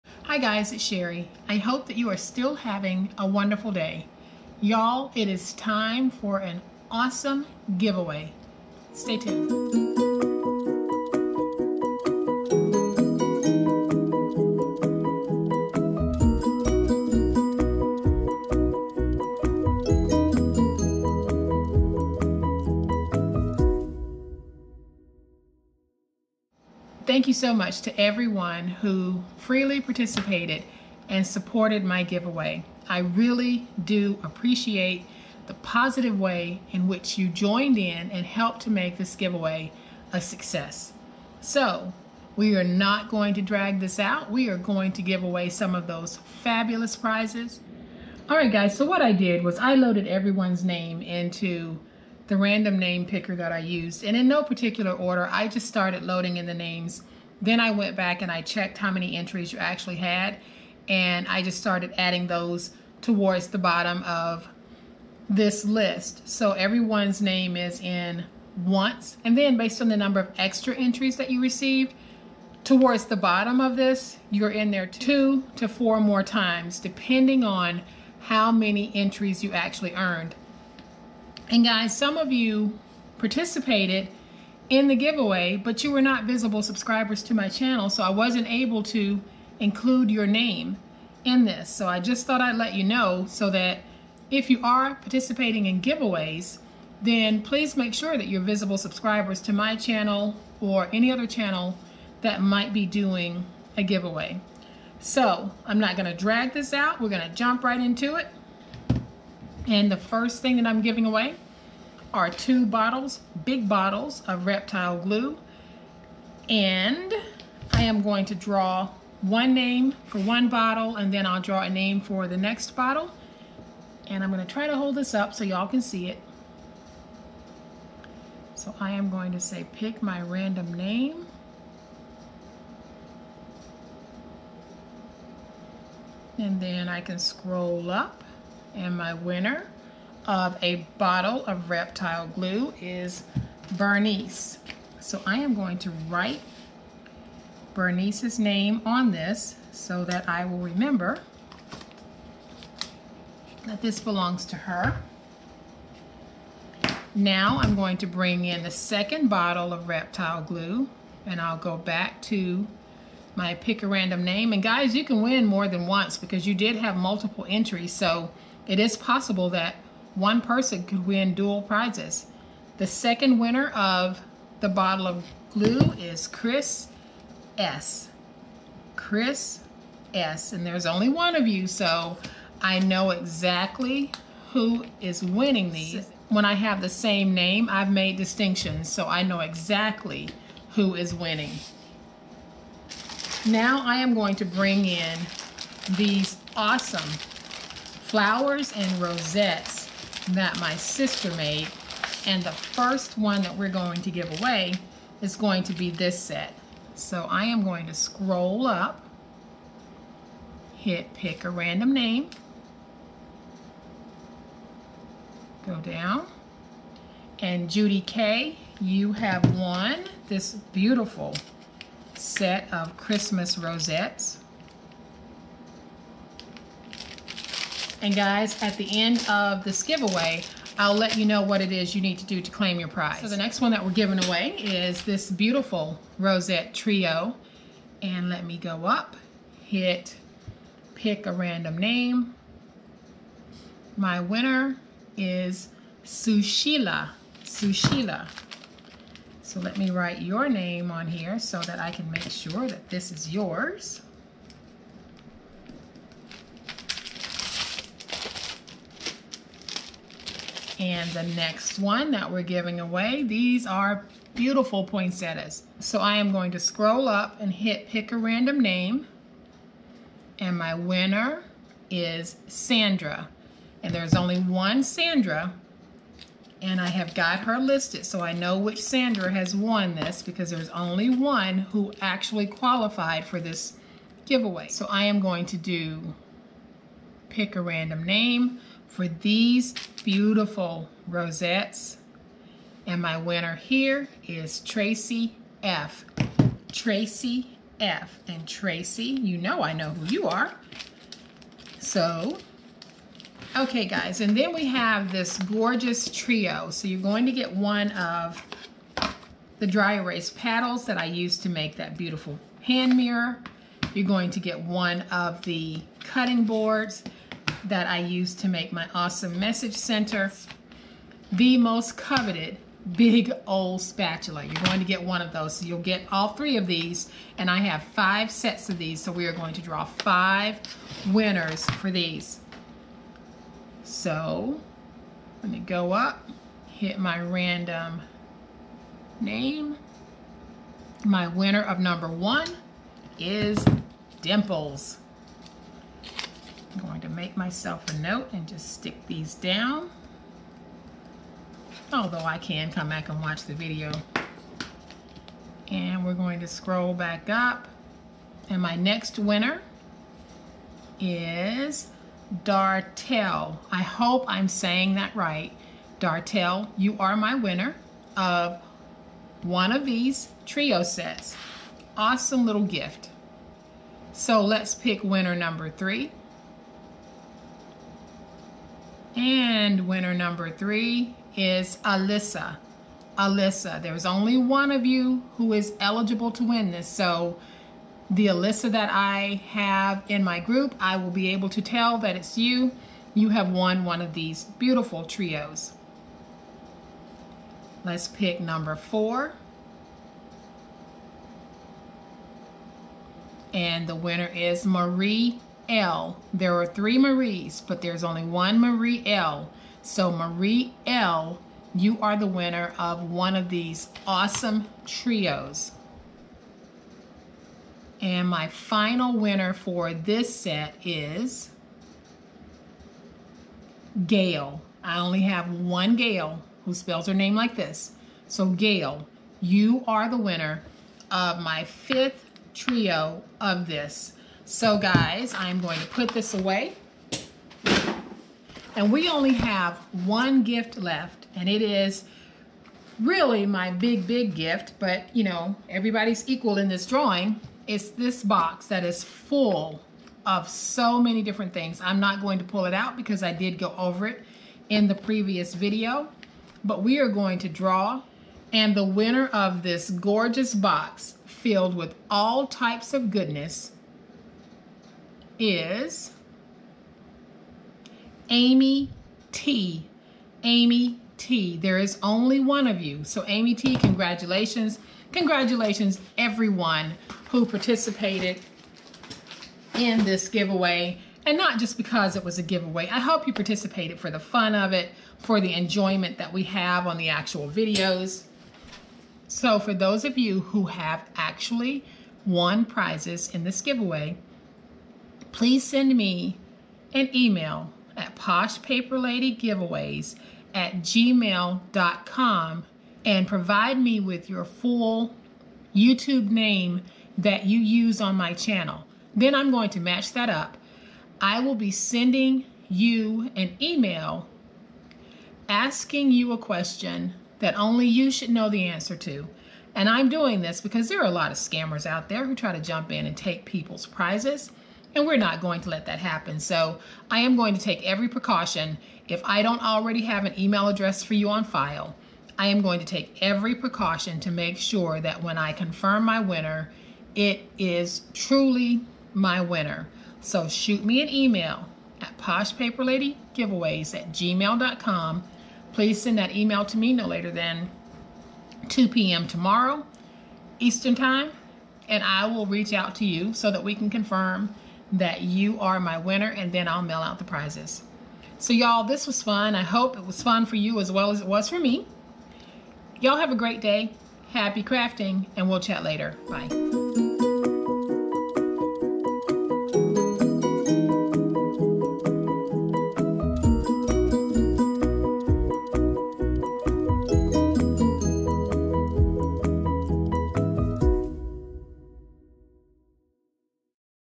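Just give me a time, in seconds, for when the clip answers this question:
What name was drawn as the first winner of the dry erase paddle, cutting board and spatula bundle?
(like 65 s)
344 s.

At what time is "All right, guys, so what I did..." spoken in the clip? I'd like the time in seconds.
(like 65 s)
48 s.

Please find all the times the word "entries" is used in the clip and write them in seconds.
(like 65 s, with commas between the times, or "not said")
59 s, 70 s, 78 s, 167 s.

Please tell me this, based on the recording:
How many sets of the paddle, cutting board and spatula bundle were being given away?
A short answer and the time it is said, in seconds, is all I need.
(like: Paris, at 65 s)
5, at 327 s.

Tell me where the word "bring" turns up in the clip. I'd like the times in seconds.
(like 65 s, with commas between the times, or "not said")
158 s, 194 s.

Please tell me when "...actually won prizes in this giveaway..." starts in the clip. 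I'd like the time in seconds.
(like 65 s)
491 s.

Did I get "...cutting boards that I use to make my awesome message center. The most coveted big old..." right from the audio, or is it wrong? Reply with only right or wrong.
right.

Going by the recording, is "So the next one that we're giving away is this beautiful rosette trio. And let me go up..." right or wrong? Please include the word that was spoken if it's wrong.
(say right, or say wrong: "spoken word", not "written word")
right.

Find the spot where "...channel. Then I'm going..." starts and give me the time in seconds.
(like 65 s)
508 s.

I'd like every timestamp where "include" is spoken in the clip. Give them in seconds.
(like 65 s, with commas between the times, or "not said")
89 s.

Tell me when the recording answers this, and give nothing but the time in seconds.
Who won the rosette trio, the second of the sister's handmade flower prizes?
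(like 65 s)
243 s.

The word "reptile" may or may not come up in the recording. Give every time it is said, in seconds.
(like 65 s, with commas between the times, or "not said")
114 s, 141 s, 159 s.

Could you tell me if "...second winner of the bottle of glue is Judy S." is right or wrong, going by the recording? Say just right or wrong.
wrong.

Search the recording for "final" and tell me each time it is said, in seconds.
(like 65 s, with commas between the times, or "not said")
418 s.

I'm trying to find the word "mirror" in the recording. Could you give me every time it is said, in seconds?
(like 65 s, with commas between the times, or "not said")
312 s.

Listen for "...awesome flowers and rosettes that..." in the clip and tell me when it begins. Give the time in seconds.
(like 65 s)
196 s.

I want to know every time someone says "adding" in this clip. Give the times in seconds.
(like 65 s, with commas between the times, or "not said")
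61 s.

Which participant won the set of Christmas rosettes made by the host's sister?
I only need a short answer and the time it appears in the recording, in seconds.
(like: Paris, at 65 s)
Judy K, at 217 s.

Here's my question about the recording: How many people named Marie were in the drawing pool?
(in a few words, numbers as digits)
3.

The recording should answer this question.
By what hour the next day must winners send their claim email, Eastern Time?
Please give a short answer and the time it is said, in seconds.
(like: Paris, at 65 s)
2 p.m., at 548 s.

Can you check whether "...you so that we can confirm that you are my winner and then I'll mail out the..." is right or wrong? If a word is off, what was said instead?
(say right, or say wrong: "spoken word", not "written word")
right.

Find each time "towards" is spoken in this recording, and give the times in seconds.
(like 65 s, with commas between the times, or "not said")
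63 s, 72 s.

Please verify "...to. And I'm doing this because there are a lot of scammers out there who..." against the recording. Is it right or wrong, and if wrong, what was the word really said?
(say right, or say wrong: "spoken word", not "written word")
right.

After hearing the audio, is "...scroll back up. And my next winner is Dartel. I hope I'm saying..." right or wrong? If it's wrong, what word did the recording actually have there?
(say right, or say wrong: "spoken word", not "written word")
right.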